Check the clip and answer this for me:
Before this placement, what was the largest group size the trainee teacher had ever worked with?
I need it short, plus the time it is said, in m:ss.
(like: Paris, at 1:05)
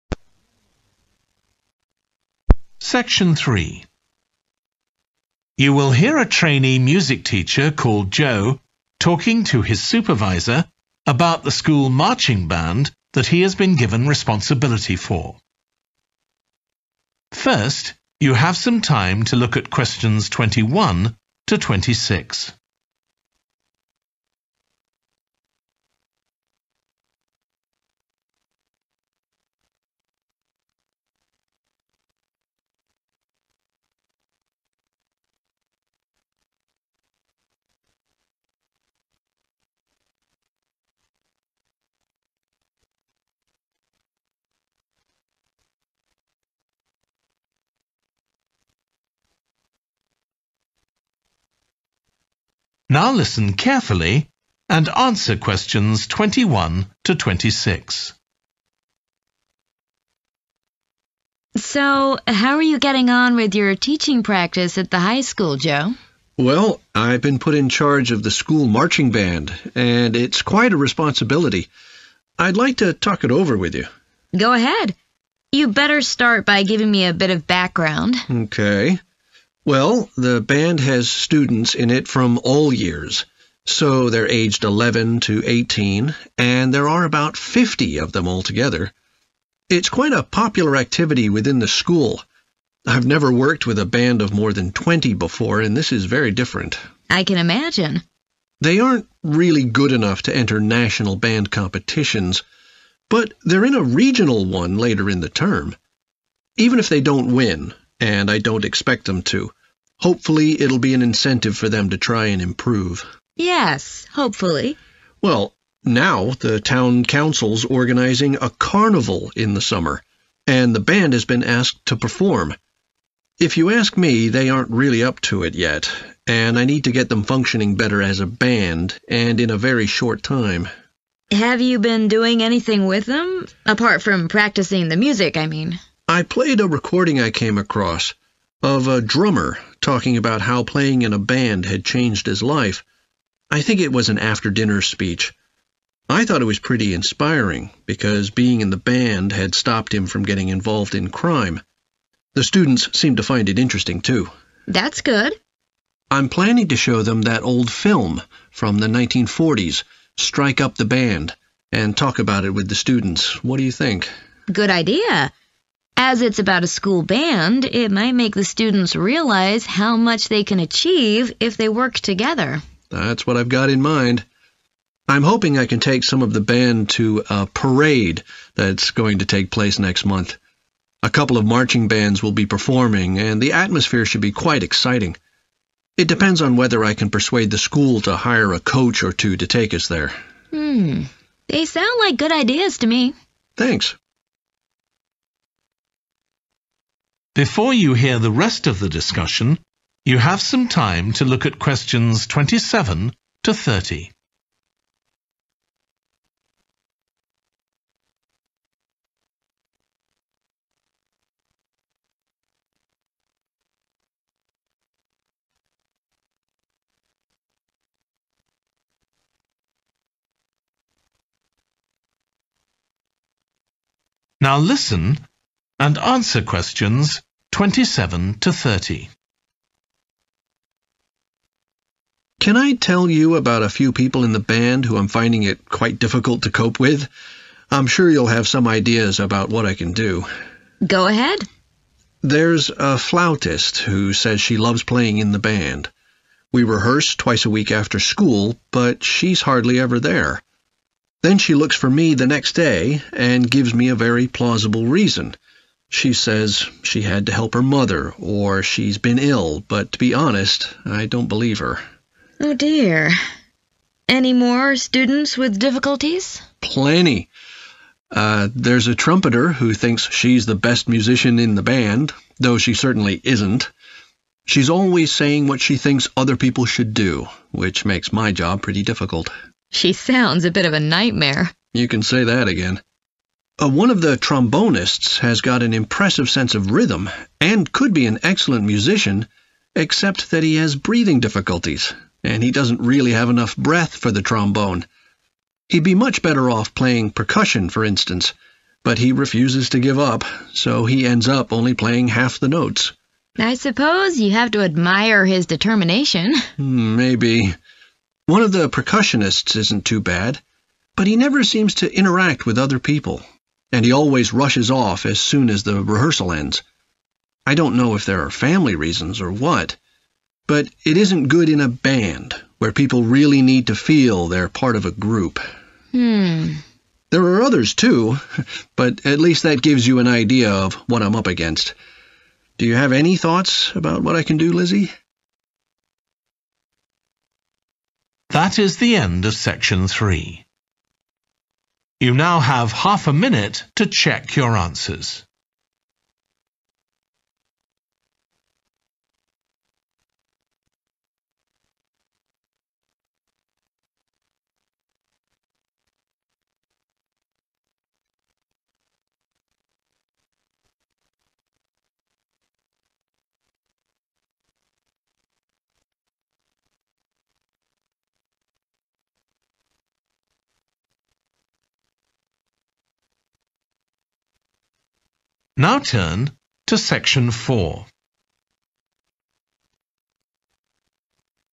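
20, at 1:34.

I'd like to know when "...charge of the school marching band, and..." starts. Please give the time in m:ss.
1:07.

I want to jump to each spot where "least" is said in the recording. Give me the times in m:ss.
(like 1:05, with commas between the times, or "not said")
5:29.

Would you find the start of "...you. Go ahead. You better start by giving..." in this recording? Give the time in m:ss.
1:13.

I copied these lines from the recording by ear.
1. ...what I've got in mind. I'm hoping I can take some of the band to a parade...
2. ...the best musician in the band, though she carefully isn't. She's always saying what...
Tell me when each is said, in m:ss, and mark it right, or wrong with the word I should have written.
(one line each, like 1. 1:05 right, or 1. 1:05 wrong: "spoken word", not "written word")
1. 2:53 right
2. 4:30 wrong: "certainly", not "carefully".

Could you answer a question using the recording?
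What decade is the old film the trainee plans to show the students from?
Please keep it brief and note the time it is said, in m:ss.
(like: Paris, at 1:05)
1940s, at 2:38.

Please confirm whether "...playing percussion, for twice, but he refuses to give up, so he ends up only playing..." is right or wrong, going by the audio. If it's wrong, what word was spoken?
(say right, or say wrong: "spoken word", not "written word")
wrong: "instance", not "twice".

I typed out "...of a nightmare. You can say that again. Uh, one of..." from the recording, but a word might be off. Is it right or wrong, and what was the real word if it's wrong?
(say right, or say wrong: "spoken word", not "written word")
right.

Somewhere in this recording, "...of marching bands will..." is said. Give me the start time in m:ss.
3:01.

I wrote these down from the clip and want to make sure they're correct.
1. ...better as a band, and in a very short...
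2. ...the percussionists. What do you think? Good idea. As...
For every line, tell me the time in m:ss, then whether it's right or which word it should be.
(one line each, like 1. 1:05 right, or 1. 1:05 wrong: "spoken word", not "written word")
1. 2:07 right
2. 2:42 wrong: "students", not "percussionists".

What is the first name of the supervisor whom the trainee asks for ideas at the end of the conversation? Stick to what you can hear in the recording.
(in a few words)
Lizzie.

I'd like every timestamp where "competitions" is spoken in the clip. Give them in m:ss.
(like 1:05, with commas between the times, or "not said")
1:41.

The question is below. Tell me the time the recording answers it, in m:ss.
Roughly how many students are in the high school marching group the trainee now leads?
1:27.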